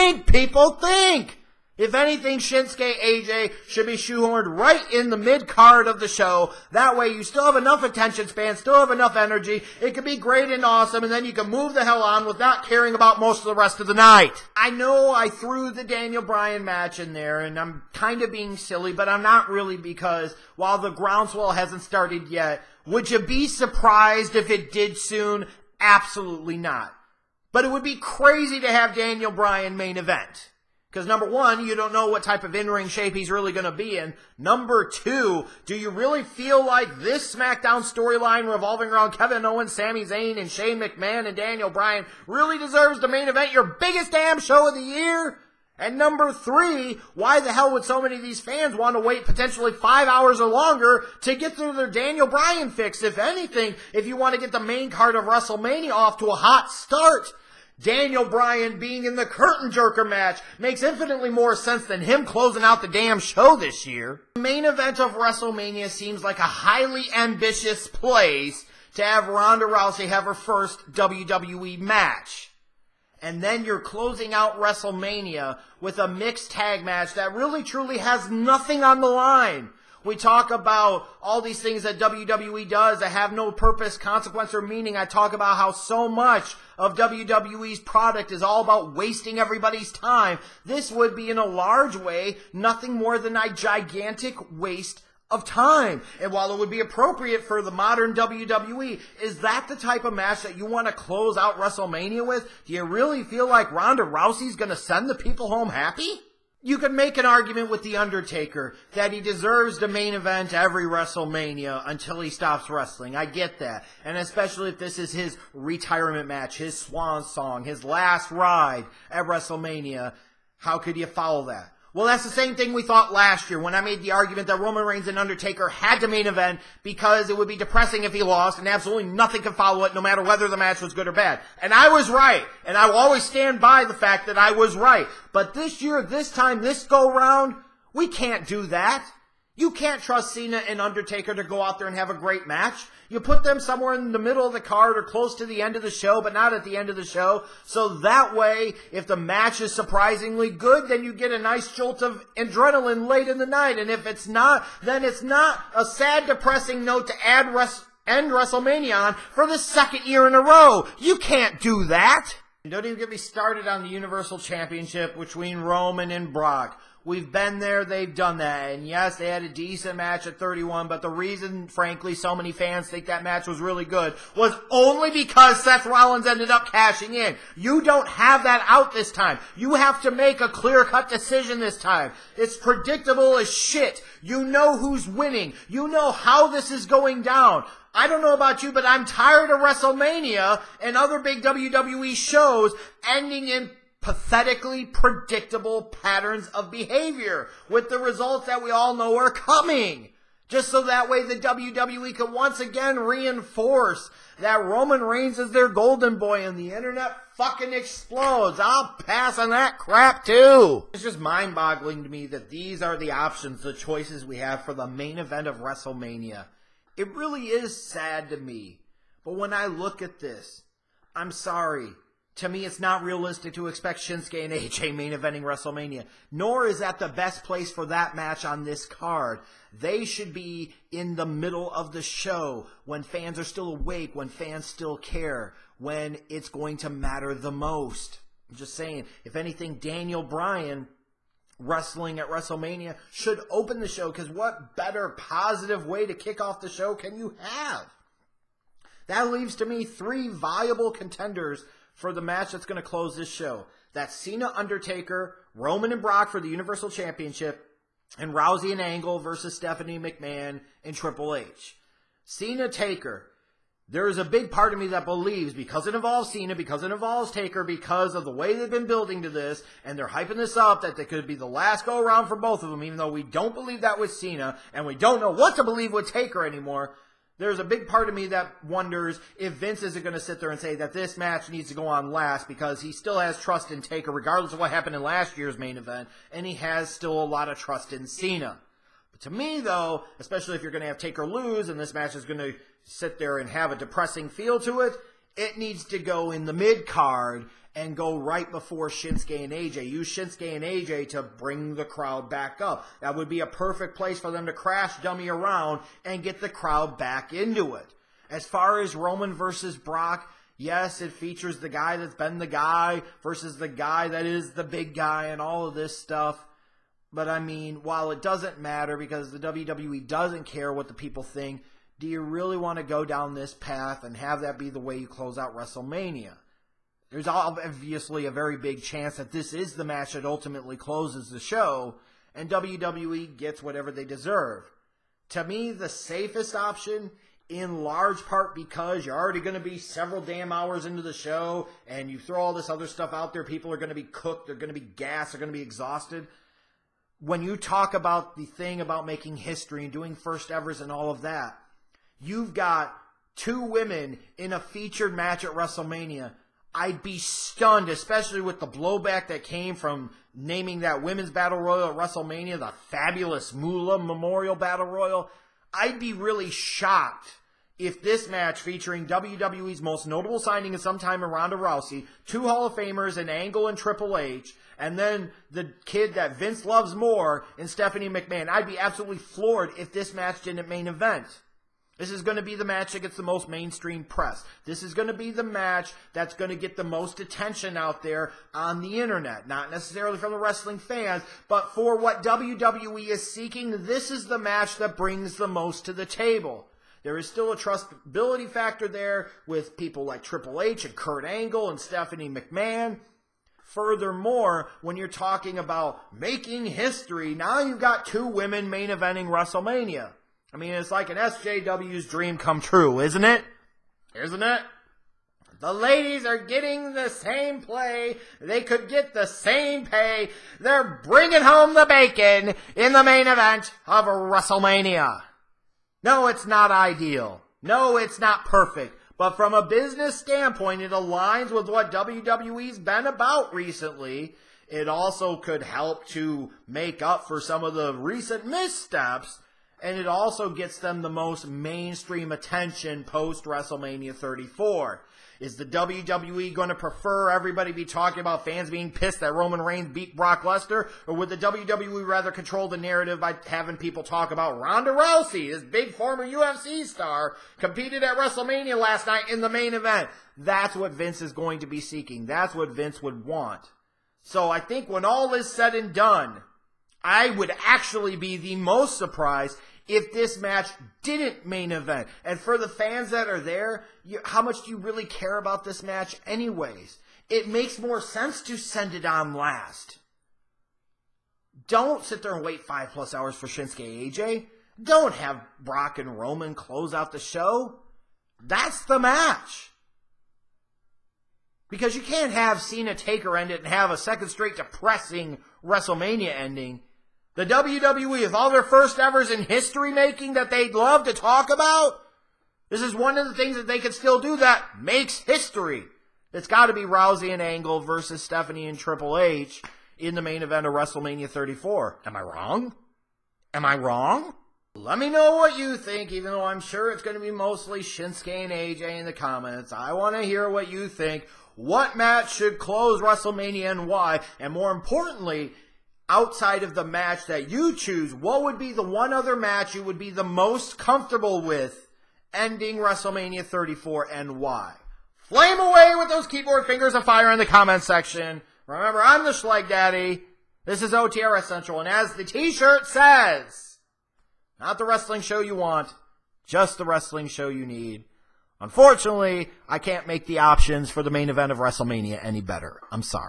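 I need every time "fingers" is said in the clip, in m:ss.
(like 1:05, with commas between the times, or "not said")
8:56.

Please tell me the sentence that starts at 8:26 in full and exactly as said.
It's got to be Rousey and Angle versus Stephanie and Triple H in the main event of WrestleMania 34.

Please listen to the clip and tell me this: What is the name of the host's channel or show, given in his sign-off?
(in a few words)
OTRSCentral.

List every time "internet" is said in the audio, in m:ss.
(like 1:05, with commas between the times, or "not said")
3:26, 6:29.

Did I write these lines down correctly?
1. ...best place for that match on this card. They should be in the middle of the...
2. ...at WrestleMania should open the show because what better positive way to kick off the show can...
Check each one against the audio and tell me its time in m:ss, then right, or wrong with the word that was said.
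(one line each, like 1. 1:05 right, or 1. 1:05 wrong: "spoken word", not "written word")
1. 3:47 right
2. 4:02 right.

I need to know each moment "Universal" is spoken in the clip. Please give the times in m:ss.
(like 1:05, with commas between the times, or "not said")
2:43, 4:16.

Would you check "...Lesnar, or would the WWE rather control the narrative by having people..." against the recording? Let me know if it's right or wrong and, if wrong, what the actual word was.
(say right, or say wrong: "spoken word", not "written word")
right.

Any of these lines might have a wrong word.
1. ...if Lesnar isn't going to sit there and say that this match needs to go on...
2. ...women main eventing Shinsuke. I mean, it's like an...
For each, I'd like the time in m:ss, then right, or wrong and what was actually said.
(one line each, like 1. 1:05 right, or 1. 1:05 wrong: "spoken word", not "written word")
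1. 4:39 wrong: "Vince", not "Lesnar"
2. 6:48 wrong: "WrestleMania", not "Shinsuke".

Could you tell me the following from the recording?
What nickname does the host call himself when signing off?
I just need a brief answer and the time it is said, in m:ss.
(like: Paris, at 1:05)
Schleg Daddy, at 8:59.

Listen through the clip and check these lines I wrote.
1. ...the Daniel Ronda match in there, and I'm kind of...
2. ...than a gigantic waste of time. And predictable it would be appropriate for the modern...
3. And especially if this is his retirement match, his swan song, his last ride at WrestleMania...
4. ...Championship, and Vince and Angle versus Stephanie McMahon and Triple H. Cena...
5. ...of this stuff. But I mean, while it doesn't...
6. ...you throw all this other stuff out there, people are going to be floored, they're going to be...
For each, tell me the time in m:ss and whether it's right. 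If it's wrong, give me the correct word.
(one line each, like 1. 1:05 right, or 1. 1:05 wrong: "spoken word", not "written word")
1. 0:15 wrong: "Bryan", not "Ronda"
2. 1:33 wrong: "while", not "predictable"
3. 1:54 right
4. 4:16 wrong: "Rousey", not "Vince"
5. 5:15 right
6. 5:42 wrong: "cooked", not "floored".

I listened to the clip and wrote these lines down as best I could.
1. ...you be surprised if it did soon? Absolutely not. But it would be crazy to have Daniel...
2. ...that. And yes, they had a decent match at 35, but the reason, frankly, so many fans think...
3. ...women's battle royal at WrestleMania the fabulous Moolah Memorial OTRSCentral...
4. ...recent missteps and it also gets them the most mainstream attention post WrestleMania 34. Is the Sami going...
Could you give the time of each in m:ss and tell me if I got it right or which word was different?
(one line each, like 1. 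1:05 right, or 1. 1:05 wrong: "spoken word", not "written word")
1. 0:23 right
2. 2:48 wrong: "31", not "35"
3. 6:01 wrong: "Battle", not "OTRSCentral"
4. 7:17 wrong: "WWE", not "Sami".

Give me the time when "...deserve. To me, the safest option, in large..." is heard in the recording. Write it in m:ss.
5:34.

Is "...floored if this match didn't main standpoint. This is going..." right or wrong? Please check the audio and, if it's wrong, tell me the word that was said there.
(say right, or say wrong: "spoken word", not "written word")
wrong: "event", not "standpoint".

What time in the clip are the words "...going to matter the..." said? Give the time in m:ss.
3:56.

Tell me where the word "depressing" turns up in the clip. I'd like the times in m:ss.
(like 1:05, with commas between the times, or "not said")
2:07, 2:36, 4:53, 8:14.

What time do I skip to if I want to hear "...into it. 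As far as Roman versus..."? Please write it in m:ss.
5:07.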